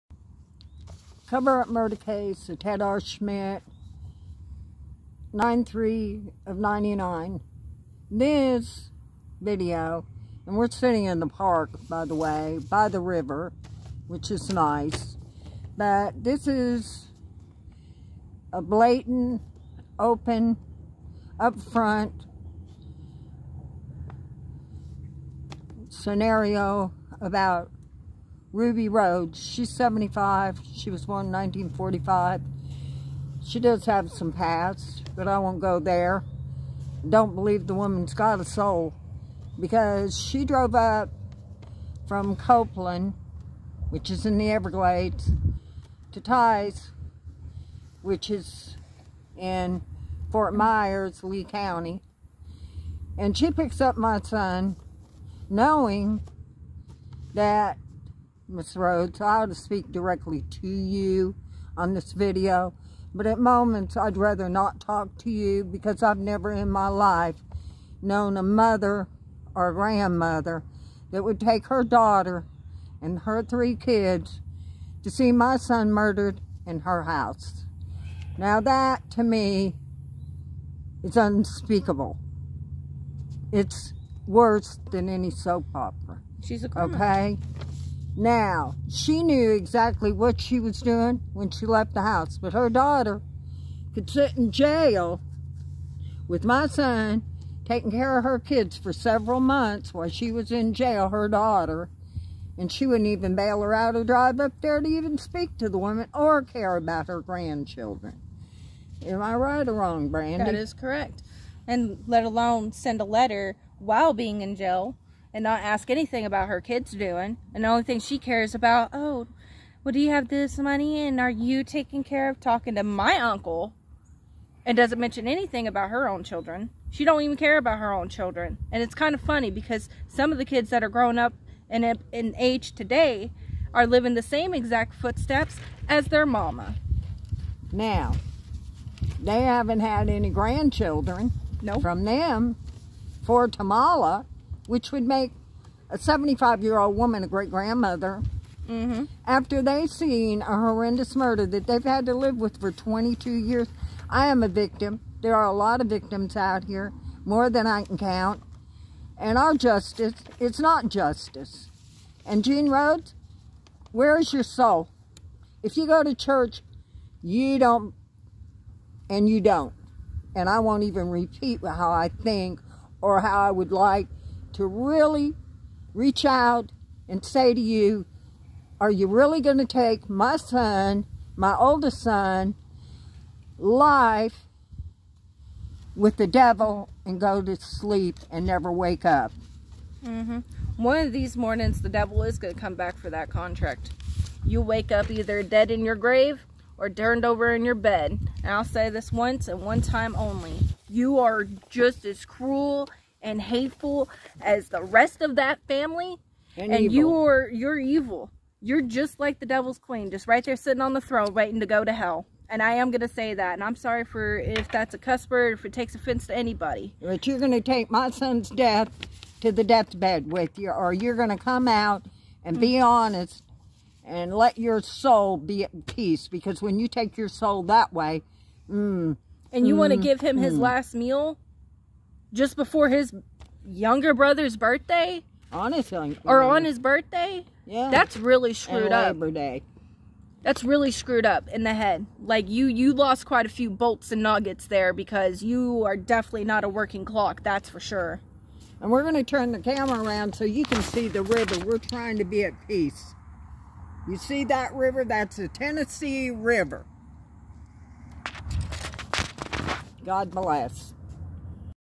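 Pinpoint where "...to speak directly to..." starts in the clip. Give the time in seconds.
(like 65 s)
59 s.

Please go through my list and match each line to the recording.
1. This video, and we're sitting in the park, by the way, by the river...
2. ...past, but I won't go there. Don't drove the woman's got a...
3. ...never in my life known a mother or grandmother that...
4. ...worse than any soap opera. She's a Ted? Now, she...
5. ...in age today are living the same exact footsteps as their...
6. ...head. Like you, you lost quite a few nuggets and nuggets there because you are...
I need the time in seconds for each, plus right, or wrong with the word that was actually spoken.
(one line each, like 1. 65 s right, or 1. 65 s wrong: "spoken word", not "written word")
1. 8 s right
2. 34 s wrong: "believe", not "drove"
3. 66 s right
4. 84 s wrong: "Okay", not "Ted"
5. 132 s right
6. 241 s wrong: "bolts", not "nuggets".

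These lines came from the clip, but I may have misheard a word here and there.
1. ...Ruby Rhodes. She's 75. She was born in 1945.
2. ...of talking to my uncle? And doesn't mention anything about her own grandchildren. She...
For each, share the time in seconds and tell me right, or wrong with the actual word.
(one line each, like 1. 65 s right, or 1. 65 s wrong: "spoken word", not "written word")
1. 28 s right
2. 122 s wrong: "children", not "grandchildren".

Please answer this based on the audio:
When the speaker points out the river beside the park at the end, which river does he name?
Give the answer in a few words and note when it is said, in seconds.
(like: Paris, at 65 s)
Tennessee River, at 255 s.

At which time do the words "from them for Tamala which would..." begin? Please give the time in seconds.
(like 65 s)
141 s.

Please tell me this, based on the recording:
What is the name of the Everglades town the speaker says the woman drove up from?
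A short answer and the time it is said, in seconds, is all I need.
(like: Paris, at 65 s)
Copeland, at 42 s.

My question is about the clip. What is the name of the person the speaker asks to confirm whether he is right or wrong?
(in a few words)
Brandy.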